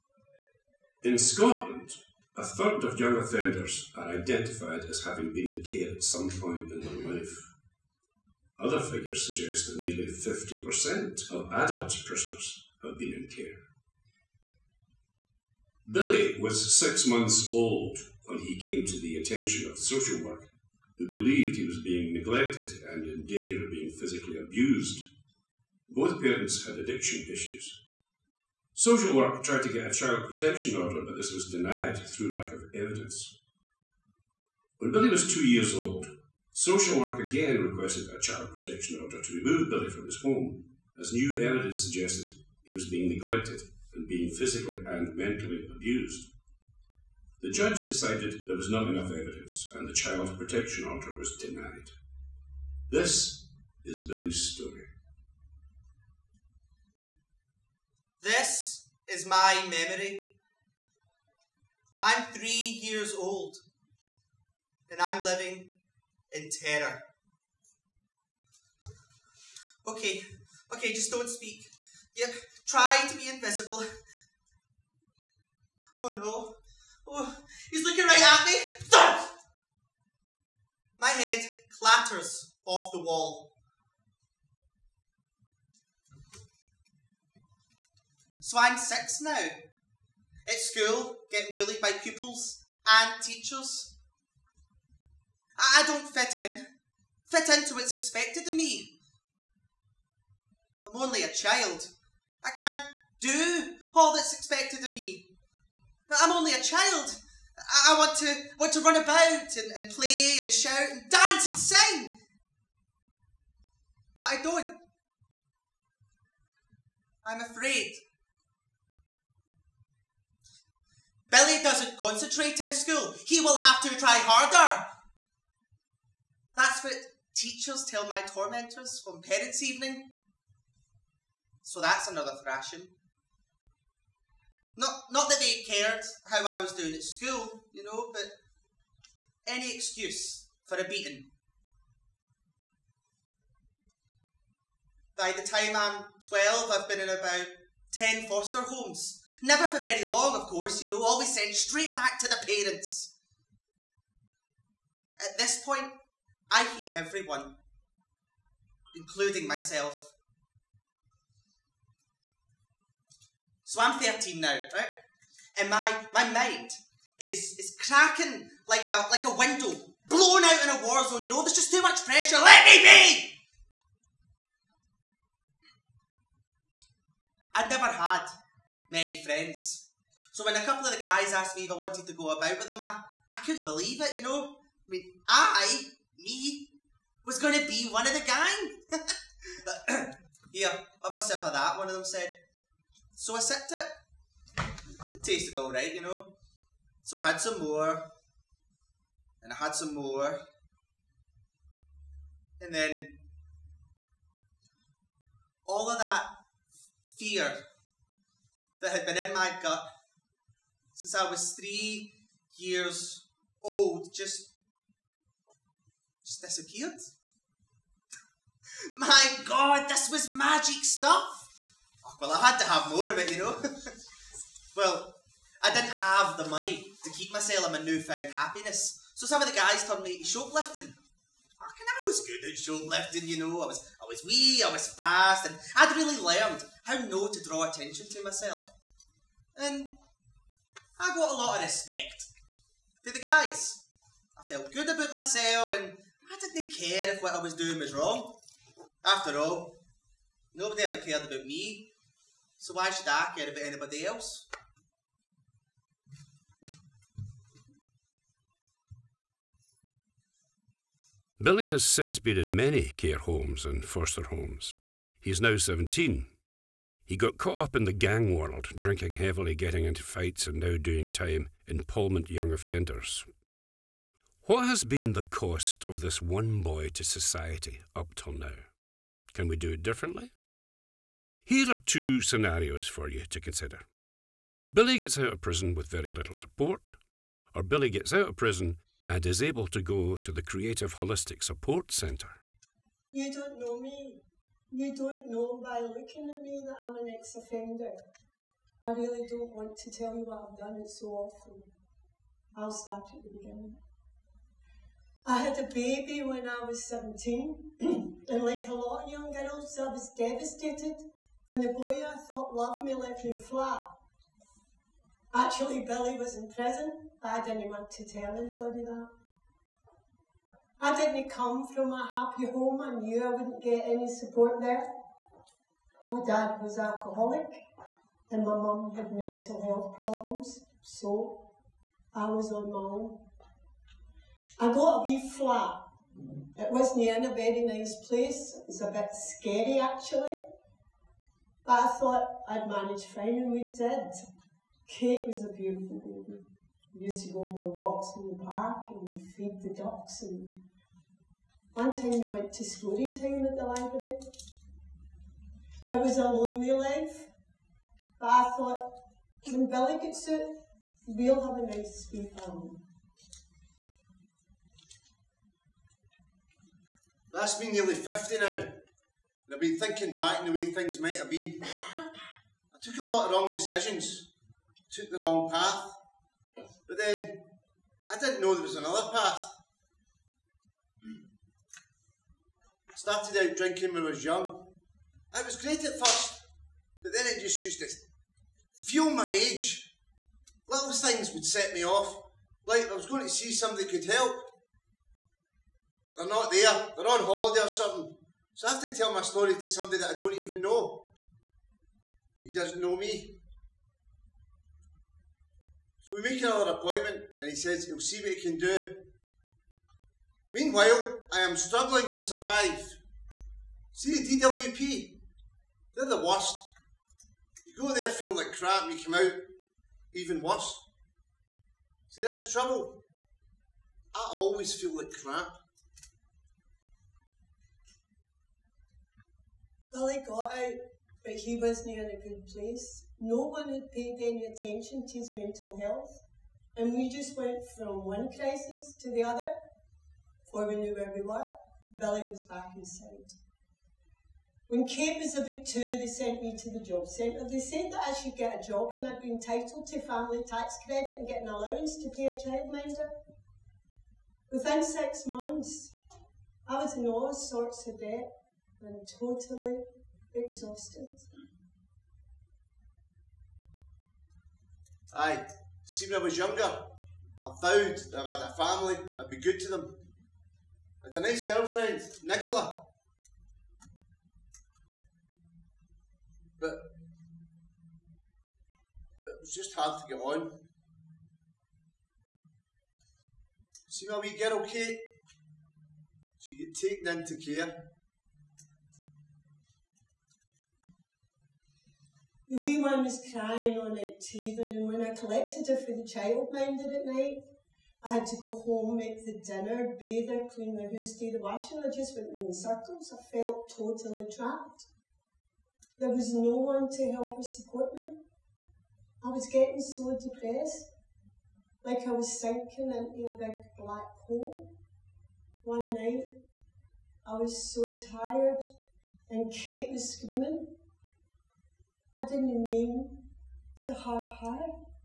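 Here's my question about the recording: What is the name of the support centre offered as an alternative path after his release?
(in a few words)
Creative Holistic Support Centre.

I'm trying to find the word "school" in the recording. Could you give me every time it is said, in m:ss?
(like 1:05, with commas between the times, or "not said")
1:30, 2:02, 2:17.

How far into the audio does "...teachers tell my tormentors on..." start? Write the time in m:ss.
2:07.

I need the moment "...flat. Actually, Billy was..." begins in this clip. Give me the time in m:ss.
5:13.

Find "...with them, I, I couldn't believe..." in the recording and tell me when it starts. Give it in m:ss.
3:02.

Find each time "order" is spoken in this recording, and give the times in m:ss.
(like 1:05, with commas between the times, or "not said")
0:30, 0:39, 0:50.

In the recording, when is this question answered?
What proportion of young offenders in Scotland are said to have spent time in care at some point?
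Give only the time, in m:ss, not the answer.
0:02.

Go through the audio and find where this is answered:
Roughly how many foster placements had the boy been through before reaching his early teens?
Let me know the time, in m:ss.
2:27.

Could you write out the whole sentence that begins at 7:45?
Aye, see when I was younger, I vowed that if I had a family, I'd be good to them.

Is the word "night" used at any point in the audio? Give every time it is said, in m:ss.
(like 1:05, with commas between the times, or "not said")
8:17, 8:35.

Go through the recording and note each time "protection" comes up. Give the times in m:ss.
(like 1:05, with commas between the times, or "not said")
0:30, 0:38, 0:50.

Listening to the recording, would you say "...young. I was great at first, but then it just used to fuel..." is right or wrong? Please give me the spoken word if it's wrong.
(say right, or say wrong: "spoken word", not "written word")
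right.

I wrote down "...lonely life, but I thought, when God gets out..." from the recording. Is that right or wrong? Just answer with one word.
wrong.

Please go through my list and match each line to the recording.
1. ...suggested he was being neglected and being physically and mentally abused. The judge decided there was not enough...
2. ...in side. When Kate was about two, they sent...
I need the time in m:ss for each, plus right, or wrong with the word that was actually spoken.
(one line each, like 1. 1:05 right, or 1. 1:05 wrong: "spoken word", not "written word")
1. 0:41 right
2. 7:22 right.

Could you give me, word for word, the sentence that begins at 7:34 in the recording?
Within six months, I was in all sorts of debt and totally exhausted.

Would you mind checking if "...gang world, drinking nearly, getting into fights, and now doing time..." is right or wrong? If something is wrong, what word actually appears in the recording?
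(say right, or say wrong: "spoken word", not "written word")
wrong: "heavily", not "nearly".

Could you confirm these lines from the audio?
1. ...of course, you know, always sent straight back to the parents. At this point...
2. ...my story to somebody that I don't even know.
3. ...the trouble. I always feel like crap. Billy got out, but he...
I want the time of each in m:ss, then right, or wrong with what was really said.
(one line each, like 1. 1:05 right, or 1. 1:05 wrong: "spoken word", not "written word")
1. 2:30 right
2. 6:39 right
3. 7:02 right.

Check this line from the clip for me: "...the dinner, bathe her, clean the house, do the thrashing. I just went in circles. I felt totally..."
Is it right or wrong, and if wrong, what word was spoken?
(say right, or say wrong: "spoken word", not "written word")
wrong: "washing", not "thrashing".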